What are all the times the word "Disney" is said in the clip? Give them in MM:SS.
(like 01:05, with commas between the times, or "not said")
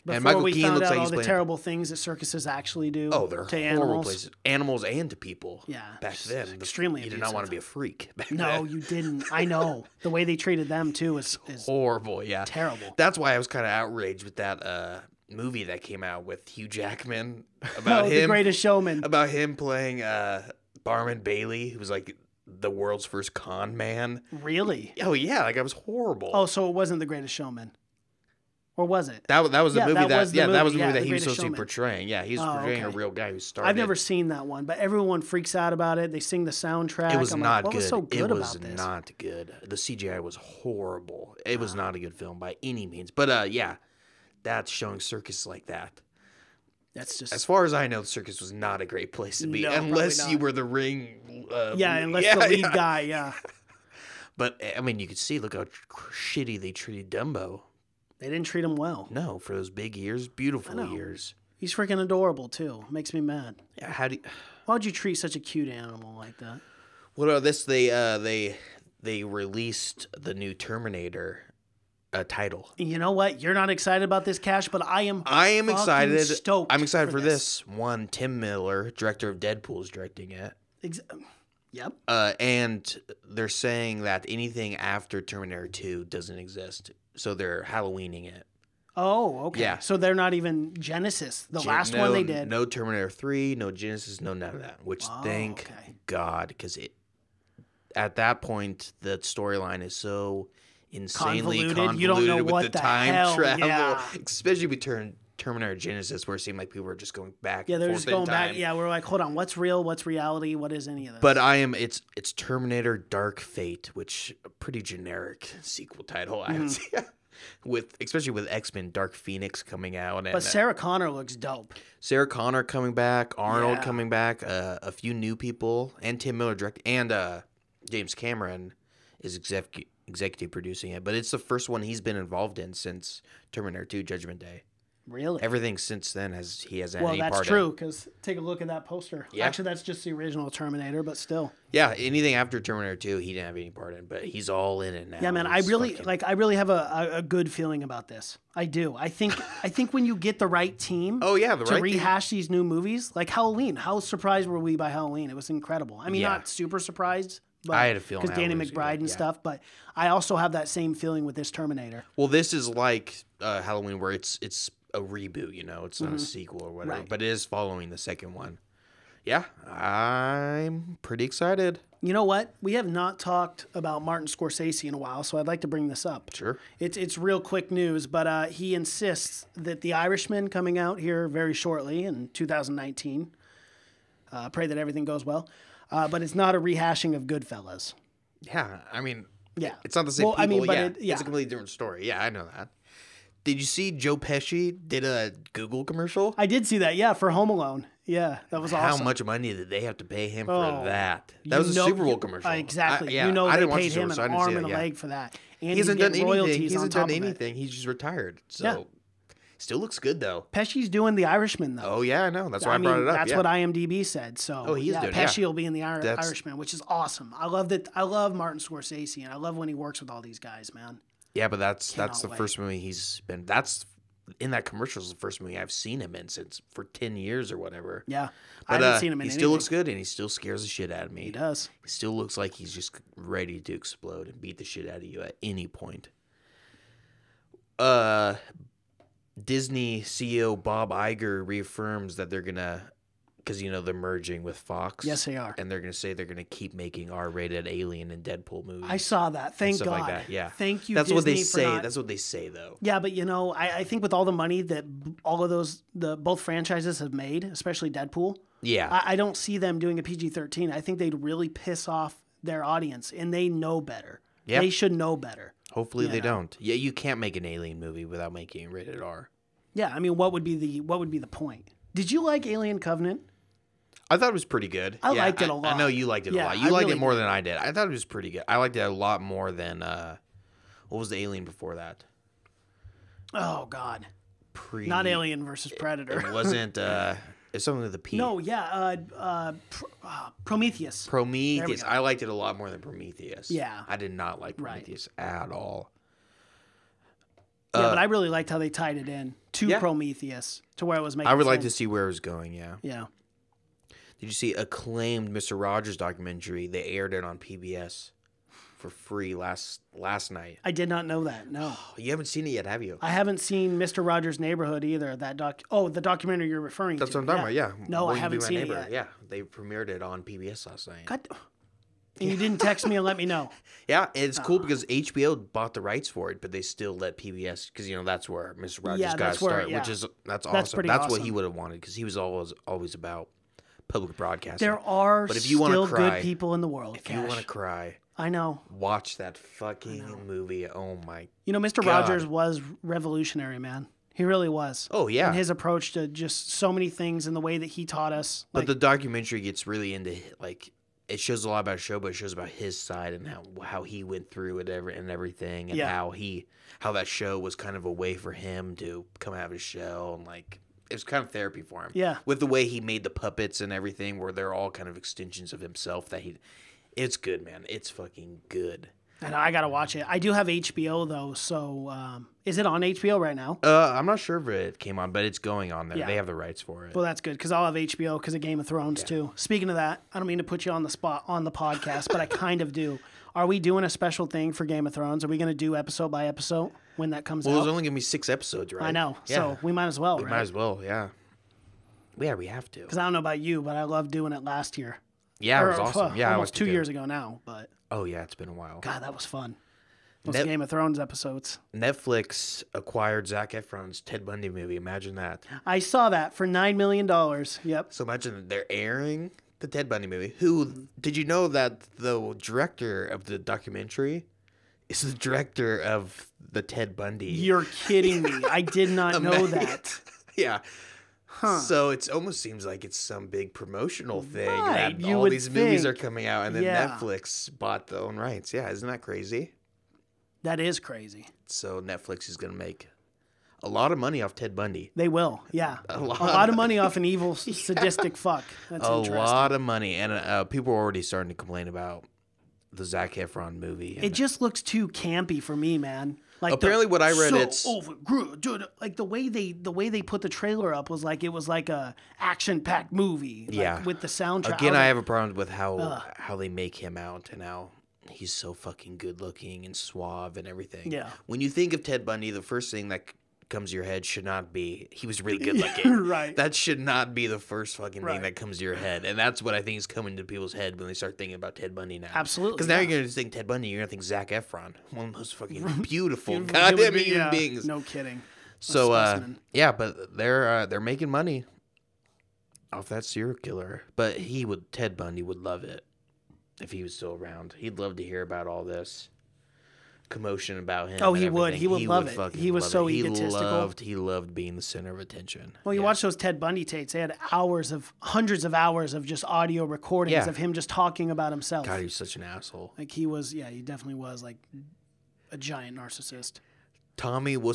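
03:59, 04:11.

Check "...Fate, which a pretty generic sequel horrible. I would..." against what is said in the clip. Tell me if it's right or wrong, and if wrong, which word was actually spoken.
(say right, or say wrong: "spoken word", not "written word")
wrong: "title", not "horrible".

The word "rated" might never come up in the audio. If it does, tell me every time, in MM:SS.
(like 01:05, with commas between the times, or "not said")
04:07, 04:28.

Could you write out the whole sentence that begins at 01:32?
No Terminator 3, no Genisys, no none of that, which oh, thank okay.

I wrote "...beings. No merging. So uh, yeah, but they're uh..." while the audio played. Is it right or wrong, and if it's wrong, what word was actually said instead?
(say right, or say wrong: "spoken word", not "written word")
wrong: "kidding", not "merging".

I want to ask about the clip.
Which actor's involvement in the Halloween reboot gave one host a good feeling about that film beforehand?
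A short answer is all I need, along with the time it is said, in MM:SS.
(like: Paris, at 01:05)
Danny McBride, at 02:38.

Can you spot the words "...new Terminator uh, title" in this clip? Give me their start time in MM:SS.
01:10.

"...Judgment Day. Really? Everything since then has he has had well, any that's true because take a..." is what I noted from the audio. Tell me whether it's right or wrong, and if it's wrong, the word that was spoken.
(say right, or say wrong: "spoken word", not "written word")
right.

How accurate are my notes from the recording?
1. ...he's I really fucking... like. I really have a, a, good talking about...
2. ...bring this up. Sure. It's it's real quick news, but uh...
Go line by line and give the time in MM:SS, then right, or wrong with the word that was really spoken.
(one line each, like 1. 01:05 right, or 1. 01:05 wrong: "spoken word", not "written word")
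1. 02:25 wrong: "feeling", not "talking"
2. 02:55 right.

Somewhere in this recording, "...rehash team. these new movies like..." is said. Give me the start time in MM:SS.
02:31.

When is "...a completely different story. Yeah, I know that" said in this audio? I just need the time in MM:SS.
03:11.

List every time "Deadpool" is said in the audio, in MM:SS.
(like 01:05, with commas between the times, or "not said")
01:19, 04:08, 04:17.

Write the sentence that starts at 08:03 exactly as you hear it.
But he would Ted Bundy would love it if he was still around.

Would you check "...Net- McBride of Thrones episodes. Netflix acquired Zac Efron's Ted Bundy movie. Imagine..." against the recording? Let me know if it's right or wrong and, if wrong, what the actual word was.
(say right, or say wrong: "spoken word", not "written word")
wrong: "Game", not "McBride".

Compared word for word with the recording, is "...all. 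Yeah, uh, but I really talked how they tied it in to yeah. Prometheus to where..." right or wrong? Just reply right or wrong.
wrong.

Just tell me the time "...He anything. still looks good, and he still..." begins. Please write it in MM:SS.
03:49.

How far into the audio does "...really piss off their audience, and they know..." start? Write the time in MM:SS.
04:21.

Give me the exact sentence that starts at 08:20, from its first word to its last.
of him just talking about himself.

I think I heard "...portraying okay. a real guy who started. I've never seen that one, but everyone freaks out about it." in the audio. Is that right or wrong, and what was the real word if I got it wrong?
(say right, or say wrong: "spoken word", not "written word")
right.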